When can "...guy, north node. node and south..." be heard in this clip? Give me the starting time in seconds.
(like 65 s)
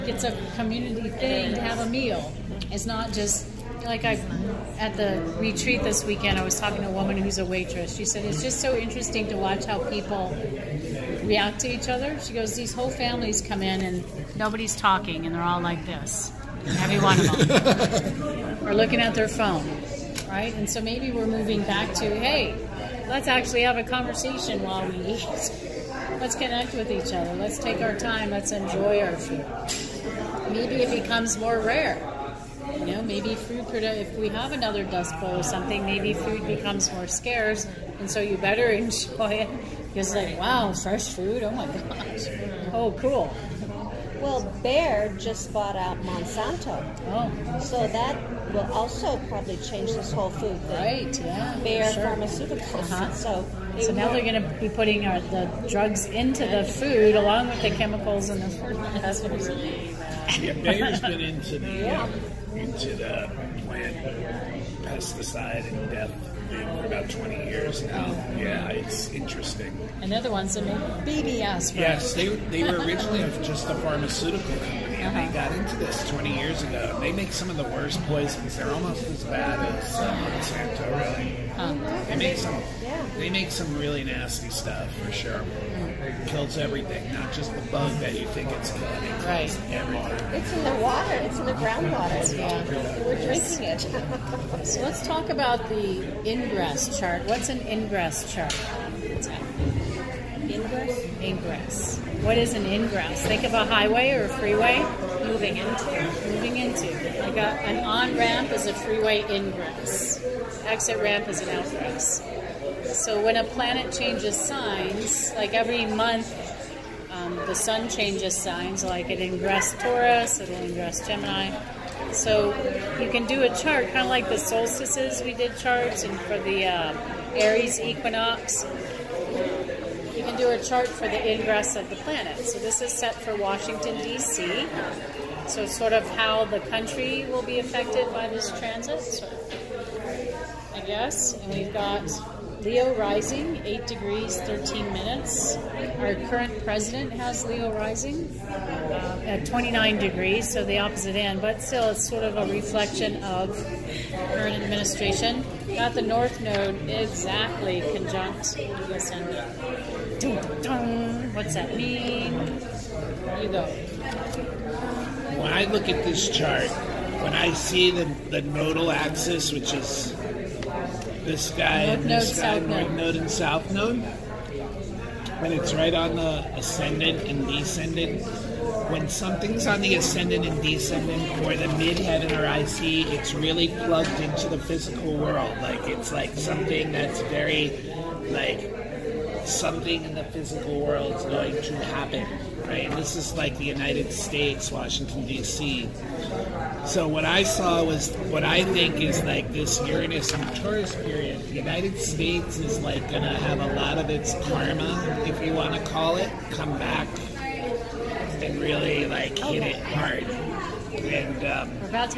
172 s.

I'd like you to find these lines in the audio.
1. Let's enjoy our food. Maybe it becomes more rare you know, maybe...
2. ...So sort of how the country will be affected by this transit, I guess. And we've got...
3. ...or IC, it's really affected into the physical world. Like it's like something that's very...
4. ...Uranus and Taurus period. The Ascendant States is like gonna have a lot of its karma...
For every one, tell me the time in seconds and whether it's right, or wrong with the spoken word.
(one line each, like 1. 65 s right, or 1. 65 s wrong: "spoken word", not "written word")
1. 28 s right
2. 135 s right
3. 182 s wrong: "plugged", not "affected"
4. 199 s wrong: "United", not "Ascendant".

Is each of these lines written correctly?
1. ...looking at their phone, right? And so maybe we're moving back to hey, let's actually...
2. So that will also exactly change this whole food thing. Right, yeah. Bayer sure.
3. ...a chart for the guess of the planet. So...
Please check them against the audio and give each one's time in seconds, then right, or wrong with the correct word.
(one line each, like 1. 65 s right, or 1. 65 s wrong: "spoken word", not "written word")
1. 18 s right
2. 47 s wrong: "probably", not "exactly"
3. 130 s wrong: "ingress", not "guess".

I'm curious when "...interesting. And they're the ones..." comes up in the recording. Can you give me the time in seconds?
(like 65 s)
69 s.